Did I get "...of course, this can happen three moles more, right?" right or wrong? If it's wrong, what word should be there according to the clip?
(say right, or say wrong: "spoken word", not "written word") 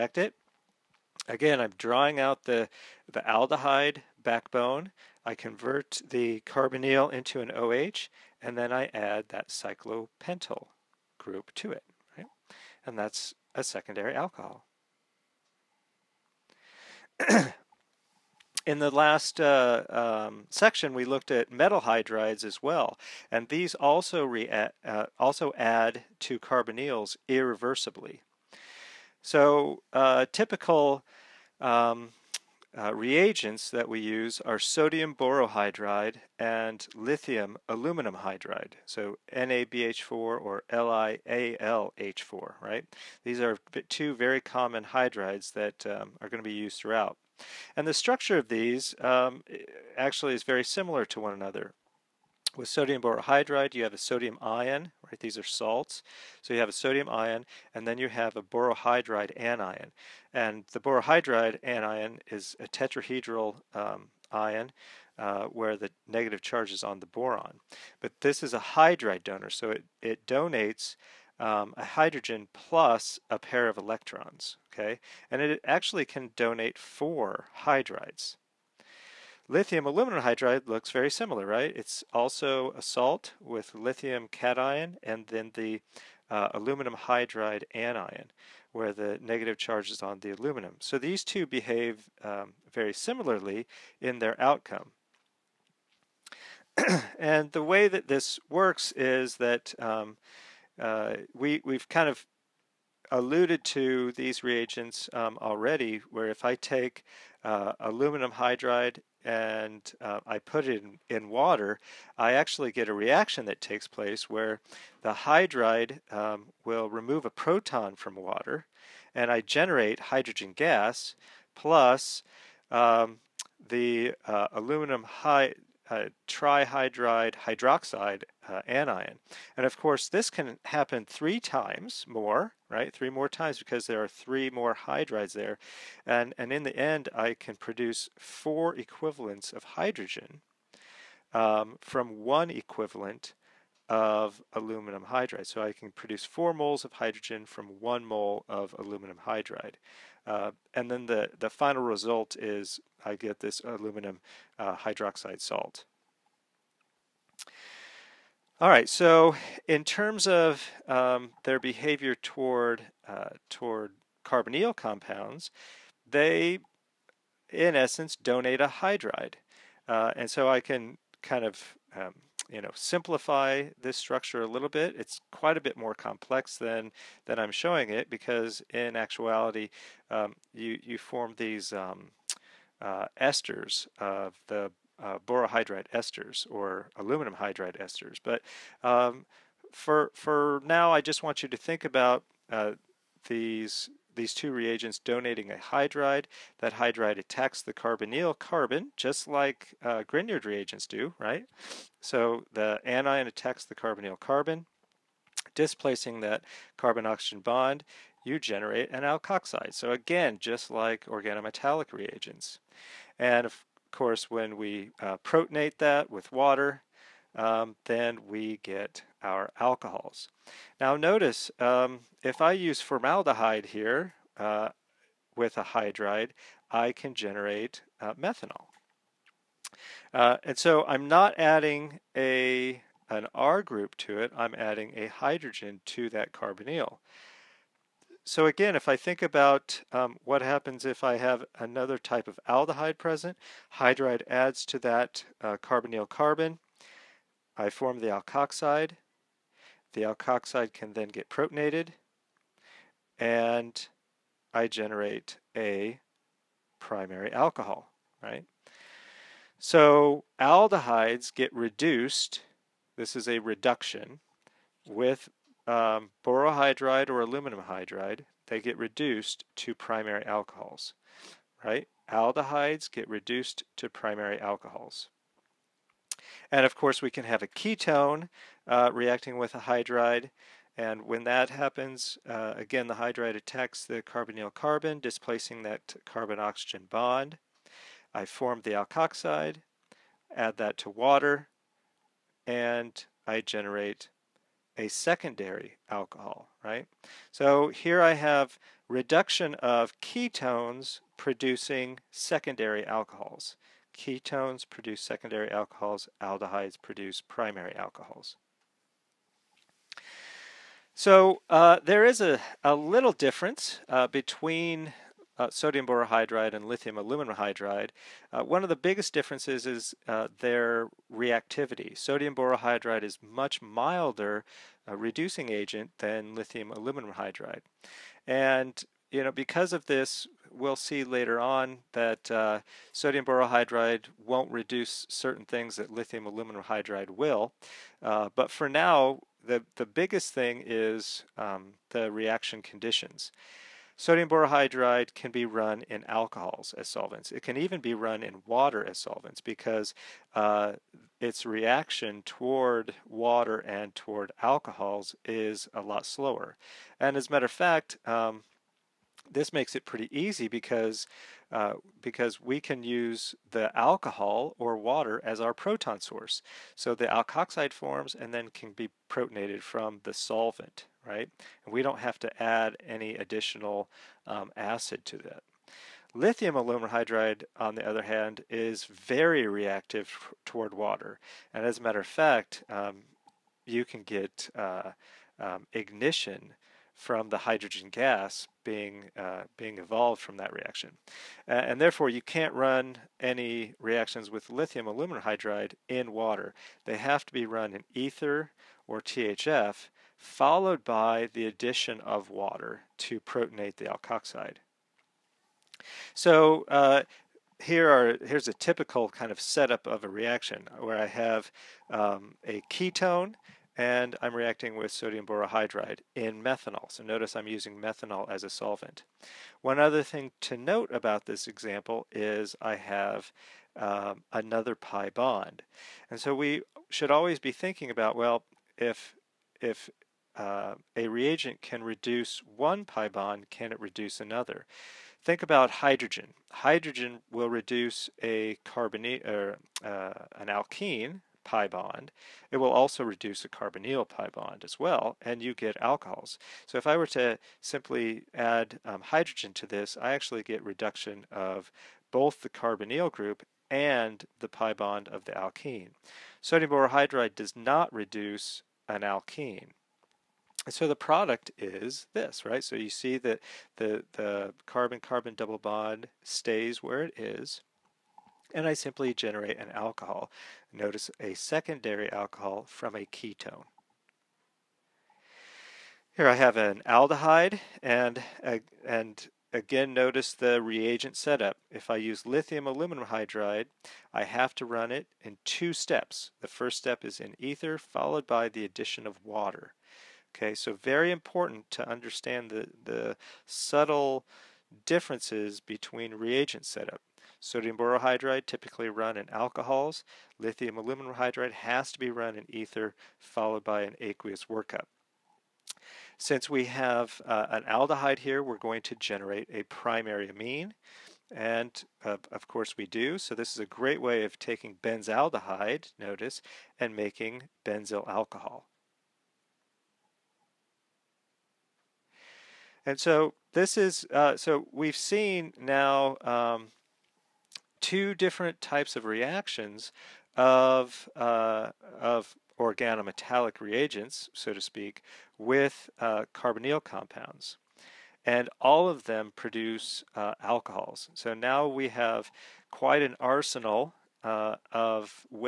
wrong: "times", not "moles".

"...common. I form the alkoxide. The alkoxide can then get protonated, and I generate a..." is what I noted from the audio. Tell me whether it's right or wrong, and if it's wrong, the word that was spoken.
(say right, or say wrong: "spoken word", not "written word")
wrong: "carbon", not "common".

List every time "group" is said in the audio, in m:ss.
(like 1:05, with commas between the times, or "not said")
0:11, 3:53, 7:33.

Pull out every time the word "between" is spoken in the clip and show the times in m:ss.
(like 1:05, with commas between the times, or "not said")
5:14, 8:15.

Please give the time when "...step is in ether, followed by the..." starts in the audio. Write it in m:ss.
8:06.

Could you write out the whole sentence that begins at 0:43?
These are two very common hydrides that um, are going to be used throughout.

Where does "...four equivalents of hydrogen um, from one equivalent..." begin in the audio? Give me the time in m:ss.
2:18.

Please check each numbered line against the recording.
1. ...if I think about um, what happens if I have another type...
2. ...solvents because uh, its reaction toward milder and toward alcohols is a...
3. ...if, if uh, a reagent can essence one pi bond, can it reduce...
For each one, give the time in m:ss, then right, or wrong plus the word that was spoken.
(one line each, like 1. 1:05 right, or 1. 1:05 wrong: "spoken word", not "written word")
1. 3:58 right
2. 5:48 wrong: "water", not "milder"
3. 7:08 wrong: "reduce", not "essence".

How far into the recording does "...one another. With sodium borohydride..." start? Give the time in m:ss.
0:51.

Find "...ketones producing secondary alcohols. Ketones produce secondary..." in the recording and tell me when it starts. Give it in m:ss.
5:00.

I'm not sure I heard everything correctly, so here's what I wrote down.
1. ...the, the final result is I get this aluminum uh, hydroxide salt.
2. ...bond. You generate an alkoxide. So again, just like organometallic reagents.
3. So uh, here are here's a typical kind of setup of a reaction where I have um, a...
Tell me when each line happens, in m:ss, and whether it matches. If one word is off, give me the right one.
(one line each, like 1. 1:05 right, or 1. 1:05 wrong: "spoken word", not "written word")
1. 2:31 right
2. 3:27 right
3. 6:46 right.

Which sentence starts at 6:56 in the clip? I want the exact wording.
So notice I'm using methanol as a solvent.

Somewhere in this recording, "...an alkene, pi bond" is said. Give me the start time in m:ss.
7:20.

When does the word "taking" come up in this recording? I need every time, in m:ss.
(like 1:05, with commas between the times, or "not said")
8:34.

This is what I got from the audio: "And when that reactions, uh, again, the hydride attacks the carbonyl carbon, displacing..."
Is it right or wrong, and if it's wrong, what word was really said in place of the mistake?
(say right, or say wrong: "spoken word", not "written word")
wrong: "happens", not "reactions".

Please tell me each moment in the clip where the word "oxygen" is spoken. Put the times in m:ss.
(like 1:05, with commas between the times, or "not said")
3:26, 4:46.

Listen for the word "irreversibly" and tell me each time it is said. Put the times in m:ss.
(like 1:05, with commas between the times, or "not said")
0:27.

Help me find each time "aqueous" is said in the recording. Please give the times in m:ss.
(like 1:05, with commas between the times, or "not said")
8:23.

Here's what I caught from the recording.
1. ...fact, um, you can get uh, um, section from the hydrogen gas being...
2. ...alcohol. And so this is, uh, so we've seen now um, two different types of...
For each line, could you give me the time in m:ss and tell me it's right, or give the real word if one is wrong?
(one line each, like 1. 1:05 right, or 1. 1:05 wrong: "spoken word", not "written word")
1. 6:22 wrong: "ignition", not "section"
2. 8:38 right.